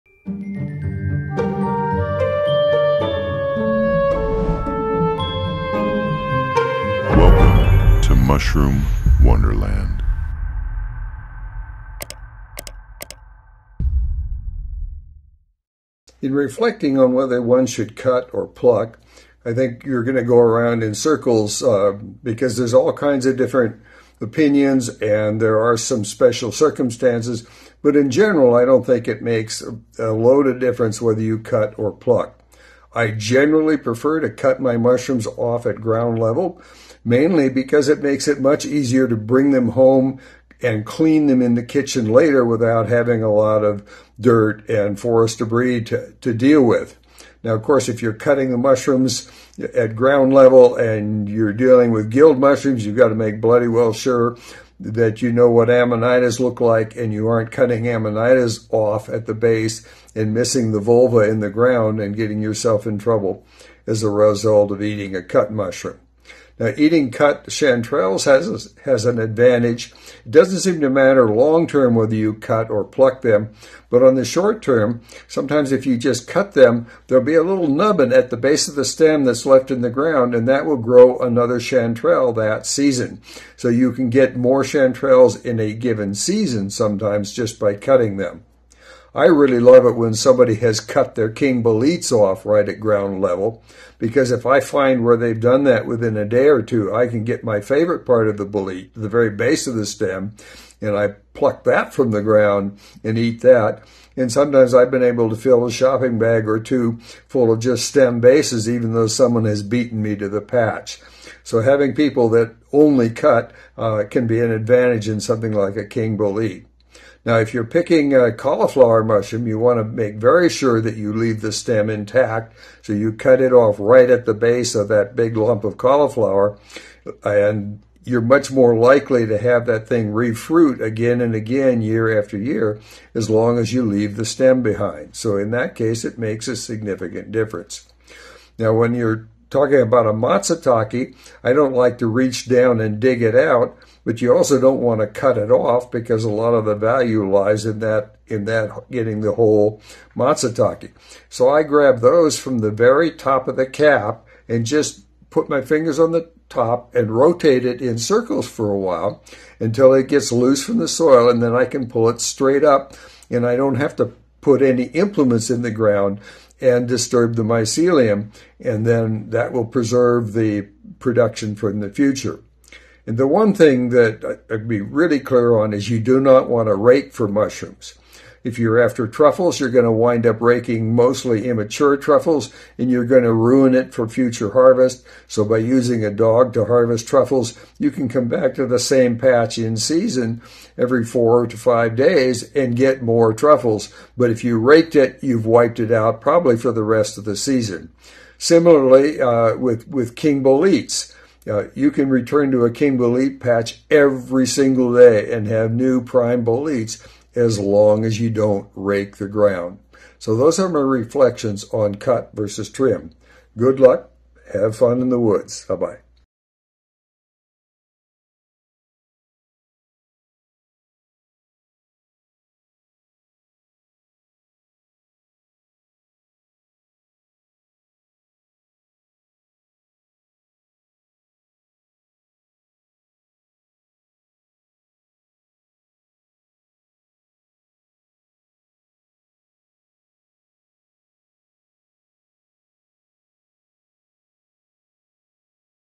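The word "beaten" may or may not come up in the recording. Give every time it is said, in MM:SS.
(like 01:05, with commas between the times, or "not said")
01:49.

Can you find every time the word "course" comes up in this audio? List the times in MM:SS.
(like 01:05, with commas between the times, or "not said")
00:47.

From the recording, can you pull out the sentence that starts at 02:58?
If you're after truffles, you're going to wind up raking mostly immature truffles and you're going to ruin it for future harvest.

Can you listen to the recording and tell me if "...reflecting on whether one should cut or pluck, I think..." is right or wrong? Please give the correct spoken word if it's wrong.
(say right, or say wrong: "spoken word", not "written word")
right.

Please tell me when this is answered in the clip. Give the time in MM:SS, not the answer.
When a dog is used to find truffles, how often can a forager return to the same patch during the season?
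03:10.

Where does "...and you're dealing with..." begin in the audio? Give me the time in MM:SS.
00:50.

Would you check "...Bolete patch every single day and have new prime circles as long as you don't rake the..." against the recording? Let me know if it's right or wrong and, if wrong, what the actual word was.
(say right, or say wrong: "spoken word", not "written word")
wrong: "boletes", not "circles".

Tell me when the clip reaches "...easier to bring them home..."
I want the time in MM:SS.
00:38.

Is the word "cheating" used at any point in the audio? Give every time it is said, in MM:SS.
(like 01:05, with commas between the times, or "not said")
not said.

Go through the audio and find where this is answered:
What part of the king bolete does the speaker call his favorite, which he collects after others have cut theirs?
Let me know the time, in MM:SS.
01:38.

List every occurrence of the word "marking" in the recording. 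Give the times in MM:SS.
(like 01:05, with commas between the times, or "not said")
not said.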